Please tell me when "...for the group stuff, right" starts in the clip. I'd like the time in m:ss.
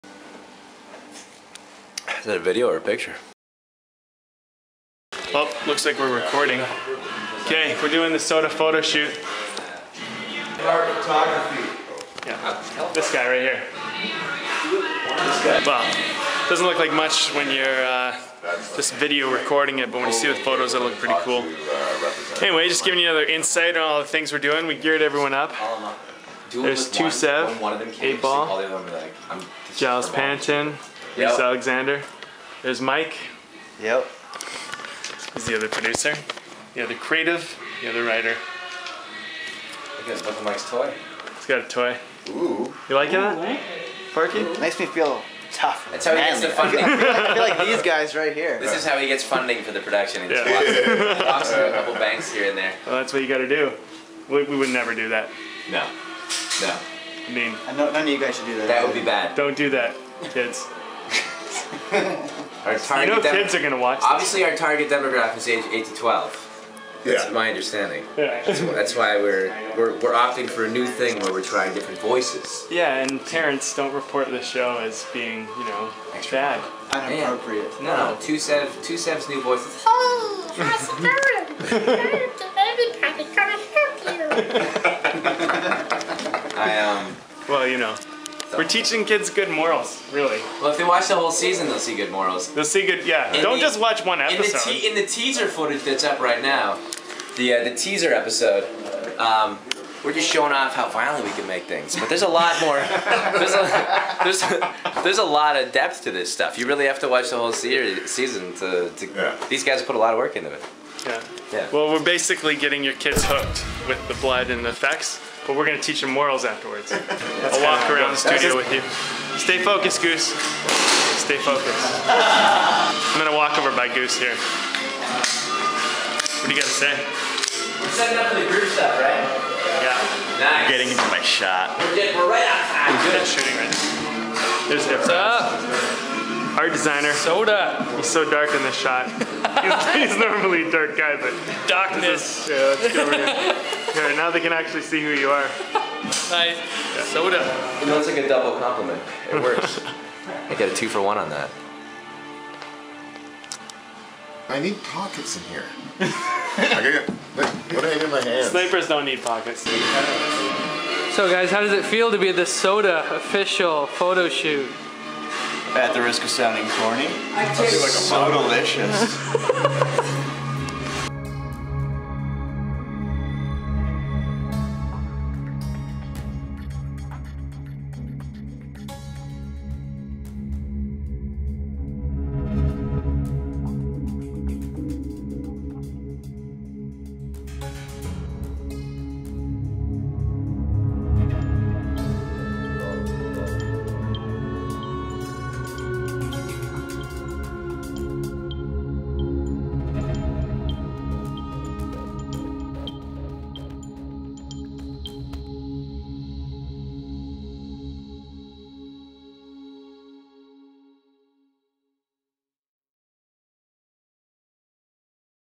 2:08.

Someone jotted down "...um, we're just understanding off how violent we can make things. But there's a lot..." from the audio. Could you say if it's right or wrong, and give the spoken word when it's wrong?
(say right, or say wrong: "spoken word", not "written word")
wrong: "showing", not "understanding".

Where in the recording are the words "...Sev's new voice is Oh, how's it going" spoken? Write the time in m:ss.
1:18.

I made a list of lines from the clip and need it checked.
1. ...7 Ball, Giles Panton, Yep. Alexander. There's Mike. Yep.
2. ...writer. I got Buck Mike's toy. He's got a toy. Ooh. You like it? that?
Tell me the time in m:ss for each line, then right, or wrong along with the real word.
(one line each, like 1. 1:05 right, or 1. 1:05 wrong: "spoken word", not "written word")
1. 0:27 wrong: "8", not "7"
2. 0:38 right.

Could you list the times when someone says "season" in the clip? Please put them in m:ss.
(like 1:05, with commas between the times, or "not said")
1:31, 1:48.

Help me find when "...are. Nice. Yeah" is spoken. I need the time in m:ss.
2:25.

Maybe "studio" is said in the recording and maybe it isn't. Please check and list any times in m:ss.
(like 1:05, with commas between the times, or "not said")
1:58.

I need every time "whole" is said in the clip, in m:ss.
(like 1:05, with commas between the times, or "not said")
1:31, 1:47.